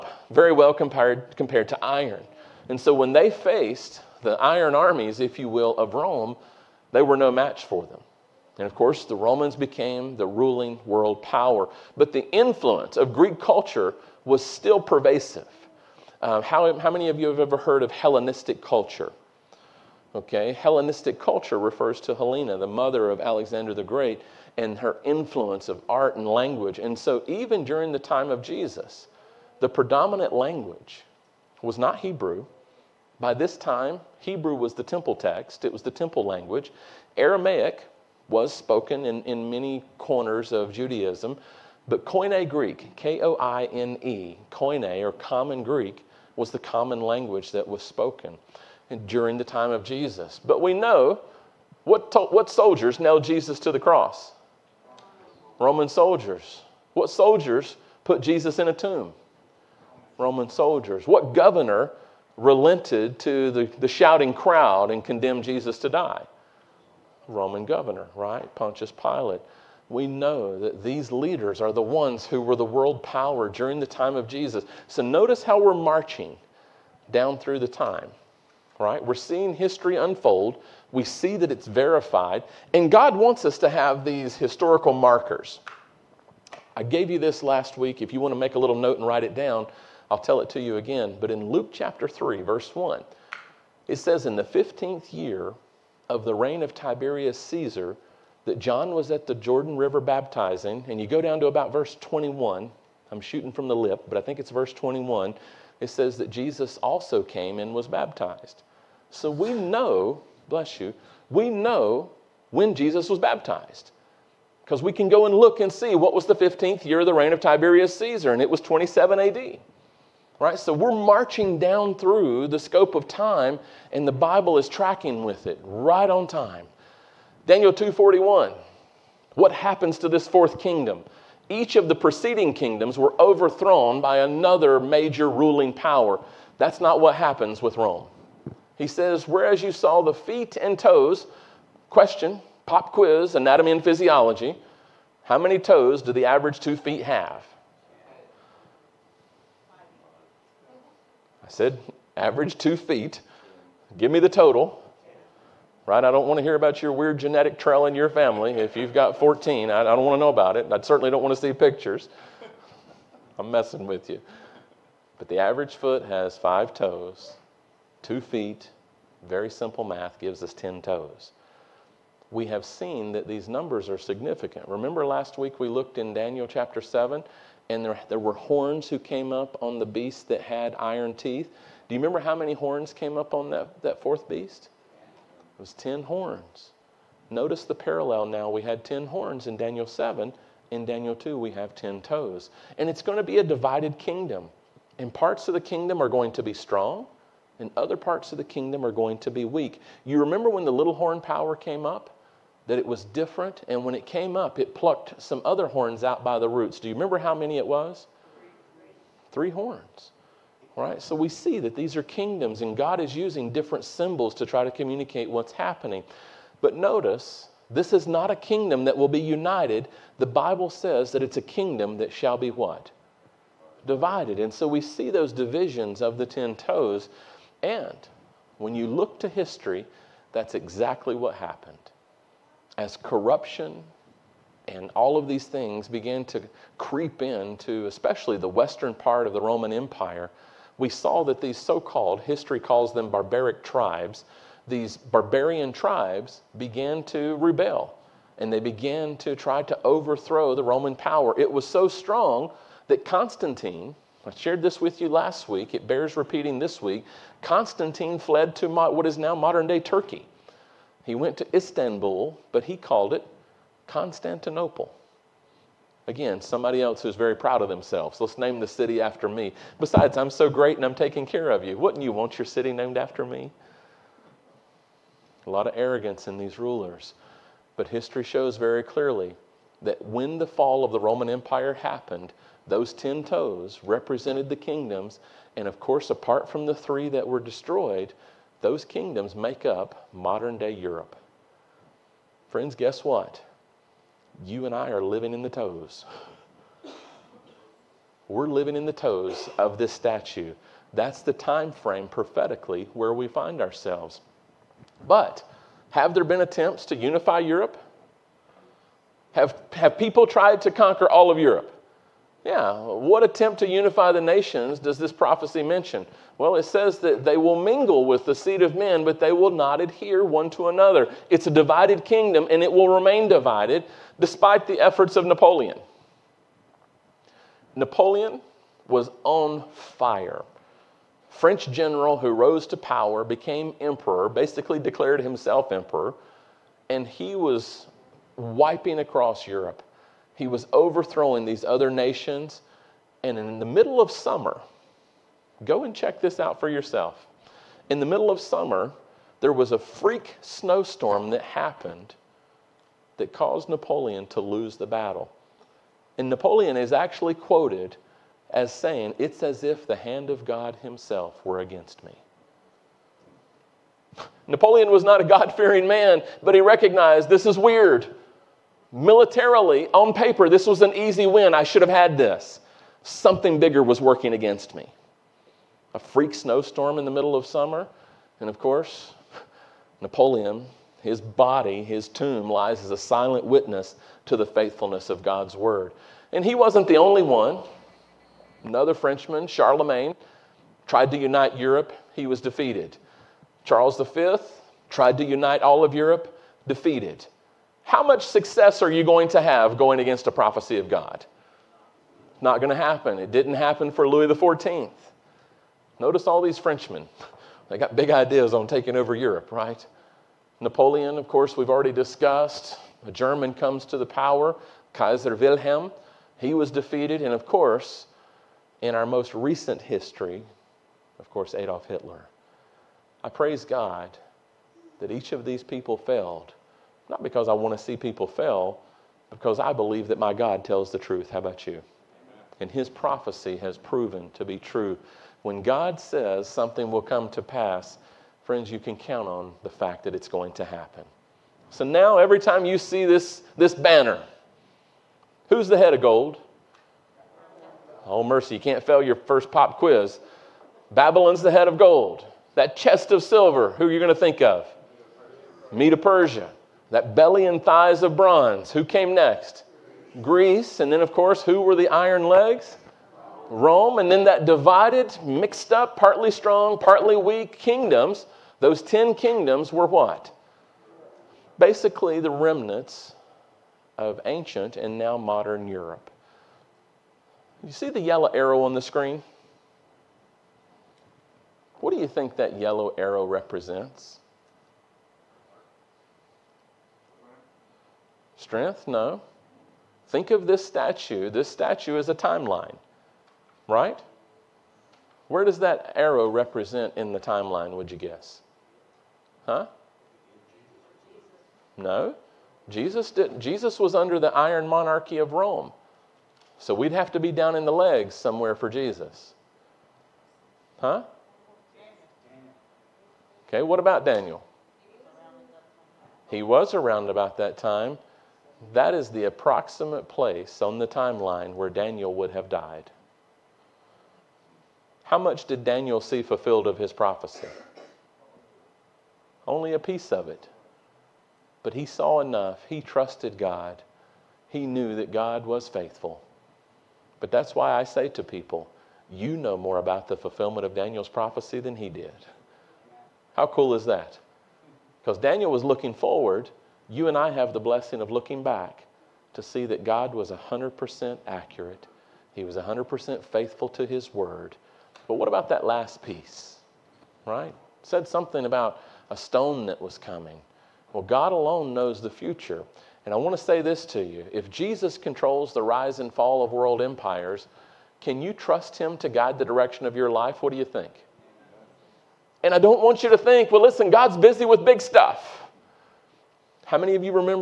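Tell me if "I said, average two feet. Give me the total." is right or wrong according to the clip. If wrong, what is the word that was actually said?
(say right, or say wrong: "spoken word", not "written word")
right.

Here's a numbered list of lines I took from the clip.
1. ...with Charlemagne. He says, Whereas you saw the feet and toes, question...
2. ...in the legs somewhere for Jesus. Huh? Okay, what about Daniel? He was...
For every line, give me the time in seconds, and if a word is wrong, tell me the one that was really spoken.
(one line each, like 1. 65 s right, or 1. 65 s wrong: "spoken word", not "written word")
1. 137 s wrong: "Rome", not "Charlemagne"
2. 507 s right.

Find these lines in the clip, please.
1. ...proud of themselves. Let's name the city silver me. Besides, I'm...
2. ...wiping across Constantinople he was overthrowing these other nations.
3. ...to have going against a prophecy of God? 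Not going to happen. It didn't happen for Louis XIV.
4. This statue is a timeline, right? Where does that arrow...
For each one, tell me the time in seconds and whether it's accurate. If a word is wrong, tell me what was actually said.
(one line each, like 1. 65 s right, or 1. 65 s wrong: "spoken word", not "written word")
1. 267 s wrong: "after", not "silver"
2. 338 s wrong: "Europe", not "Constantinople"
3. 399 s right
4. 491 s right.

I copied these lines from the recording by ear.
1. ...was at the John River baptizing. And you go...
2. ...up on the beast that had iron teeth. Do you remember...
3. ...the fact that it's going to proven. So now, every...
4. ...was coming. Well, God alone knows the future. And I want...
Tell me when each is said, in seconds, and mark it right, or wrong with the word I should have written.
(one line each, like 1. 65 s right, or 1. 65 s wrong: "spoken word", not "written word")
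1. 98 s wrong: "Jordan", not "John"
2. 179 s right
3. 439 s wrong: "happen", not "proven"
4. 559 s right.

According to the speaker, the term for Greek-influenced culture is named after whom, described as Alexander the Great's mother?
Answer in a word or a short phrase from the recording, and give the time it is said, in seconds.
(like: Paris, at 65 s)
Helena, at 22 s.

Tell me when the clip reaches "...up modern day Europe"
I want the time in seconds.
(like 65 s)
289 s.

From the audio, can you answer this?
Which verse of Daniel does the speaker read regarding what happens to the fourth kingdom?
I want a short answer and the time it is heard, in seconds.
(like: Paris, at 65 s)
Daniel 2:41, at 127 s.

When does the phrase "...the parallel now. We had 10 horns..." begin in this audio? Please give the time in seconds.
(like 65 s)
187 s.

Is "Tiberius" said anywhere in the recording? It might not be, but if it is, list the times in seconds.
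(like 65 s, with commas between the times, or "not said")
96 s, 117 s.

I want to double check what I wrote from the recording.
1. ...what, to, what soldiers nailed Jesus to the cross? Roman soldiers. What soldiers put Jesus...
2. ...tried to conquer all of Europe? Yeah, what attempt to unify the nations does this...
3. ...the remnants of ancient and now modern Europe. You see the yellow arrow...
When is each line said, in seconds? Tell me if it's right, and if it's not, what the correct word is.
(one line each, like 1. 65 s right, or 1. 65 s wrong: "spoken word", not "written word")
1. 51 s right
2. 310 s right
3. 472 s right.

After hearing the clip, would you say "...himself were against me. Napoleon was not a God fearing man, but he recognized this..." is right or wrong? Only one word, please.
right.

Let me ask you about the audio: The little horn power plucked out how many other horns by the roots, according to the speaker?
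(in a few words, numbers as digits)
3.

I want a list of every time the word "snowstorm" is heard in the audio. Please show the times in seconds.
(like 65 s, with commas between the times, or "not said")
350 s, 376 s.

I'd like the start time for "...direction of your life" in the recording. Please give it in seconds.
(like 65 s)
569 s.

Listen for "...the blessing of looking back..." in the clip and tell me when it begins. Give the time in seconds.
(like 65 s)
547 s.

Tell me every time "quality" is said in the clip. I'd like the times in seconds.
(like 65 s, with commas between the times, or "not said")
not said.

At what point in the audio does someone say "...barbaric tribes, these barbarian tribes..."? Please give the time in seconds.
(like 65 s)
243 s.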